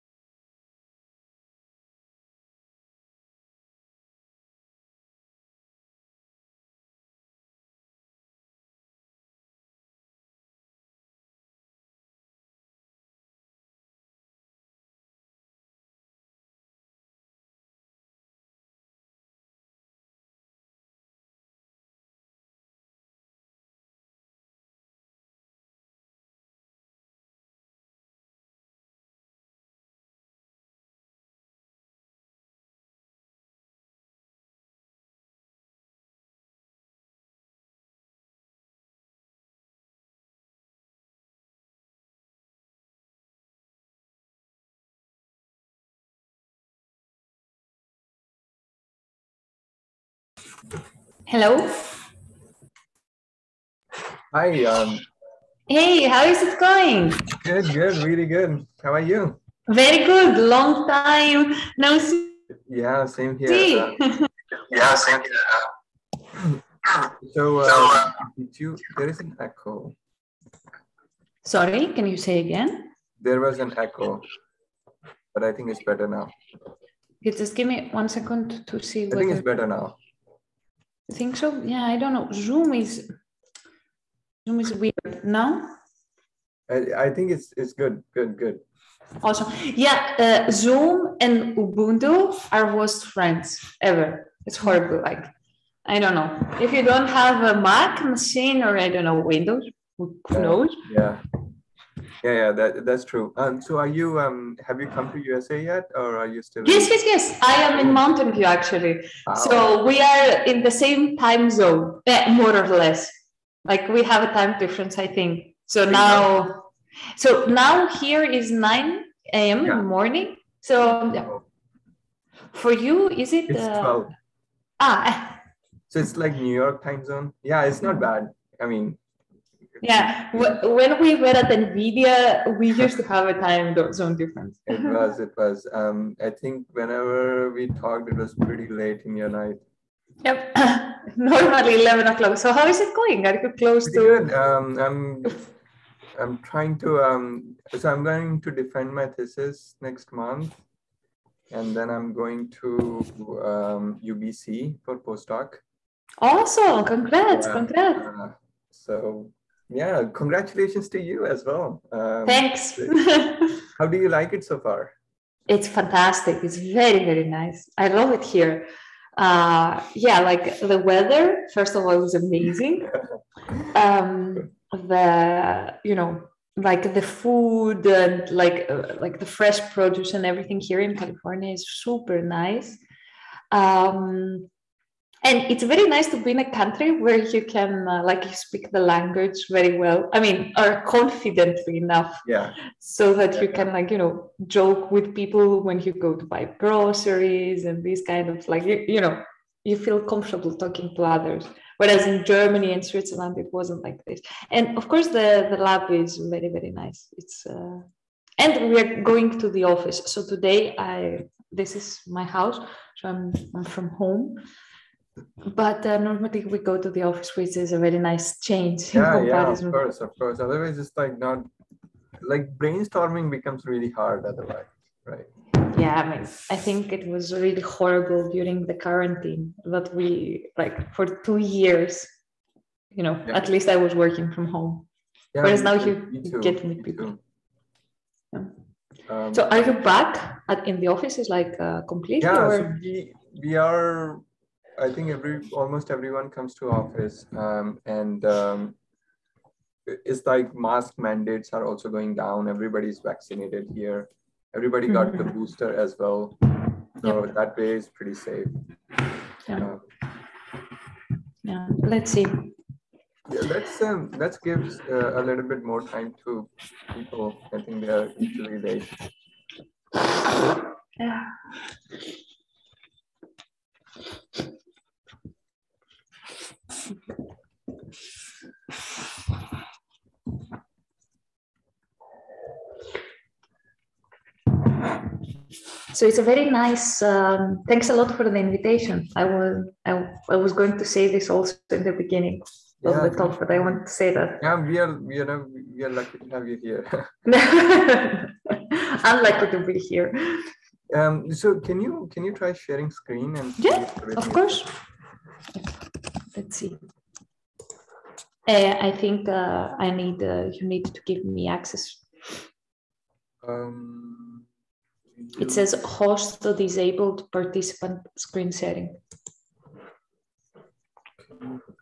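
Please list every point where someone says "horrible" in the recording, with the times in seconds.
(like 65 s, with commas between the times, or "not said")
94 s, 227 s.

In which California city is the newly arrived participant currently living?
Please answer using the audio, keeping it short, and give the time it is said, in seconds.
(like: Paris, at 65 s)
Mountain View, at 107 s.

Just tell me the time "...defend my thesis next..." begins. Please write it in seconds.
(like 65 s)
148 s.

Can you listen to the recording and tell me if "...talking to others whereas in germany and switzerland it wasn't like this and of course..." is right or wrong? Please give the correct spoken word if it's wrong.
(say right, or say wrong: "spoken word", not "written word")
right.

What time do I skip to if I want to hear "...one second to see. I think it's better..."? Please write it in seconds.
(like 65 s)
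77 s.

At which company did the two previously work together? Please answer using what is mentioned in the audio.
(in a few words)
NVIDIA.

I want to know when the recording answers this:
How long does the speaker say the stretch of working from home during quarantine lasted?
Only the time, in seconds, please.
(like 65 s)
231 s.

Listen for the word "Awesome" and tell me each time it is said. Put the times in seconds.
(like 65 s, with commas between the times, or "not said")
89 s, 156 s.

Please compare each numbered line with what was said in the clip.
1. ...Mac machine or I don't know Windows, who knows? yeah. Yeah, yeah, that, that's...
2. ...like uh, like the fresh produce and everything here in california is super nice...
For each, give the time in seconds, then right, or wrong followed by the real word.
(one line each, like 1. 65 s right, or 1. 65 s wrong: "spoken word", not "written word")
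1. 97 s right
2. 178 s right.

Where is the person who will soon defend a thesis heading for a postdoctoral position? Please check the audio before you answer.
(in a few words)
UBC.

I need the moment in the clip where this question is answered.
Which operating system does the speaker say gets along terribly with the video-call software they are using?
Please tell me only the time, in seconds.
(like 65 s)
91 s.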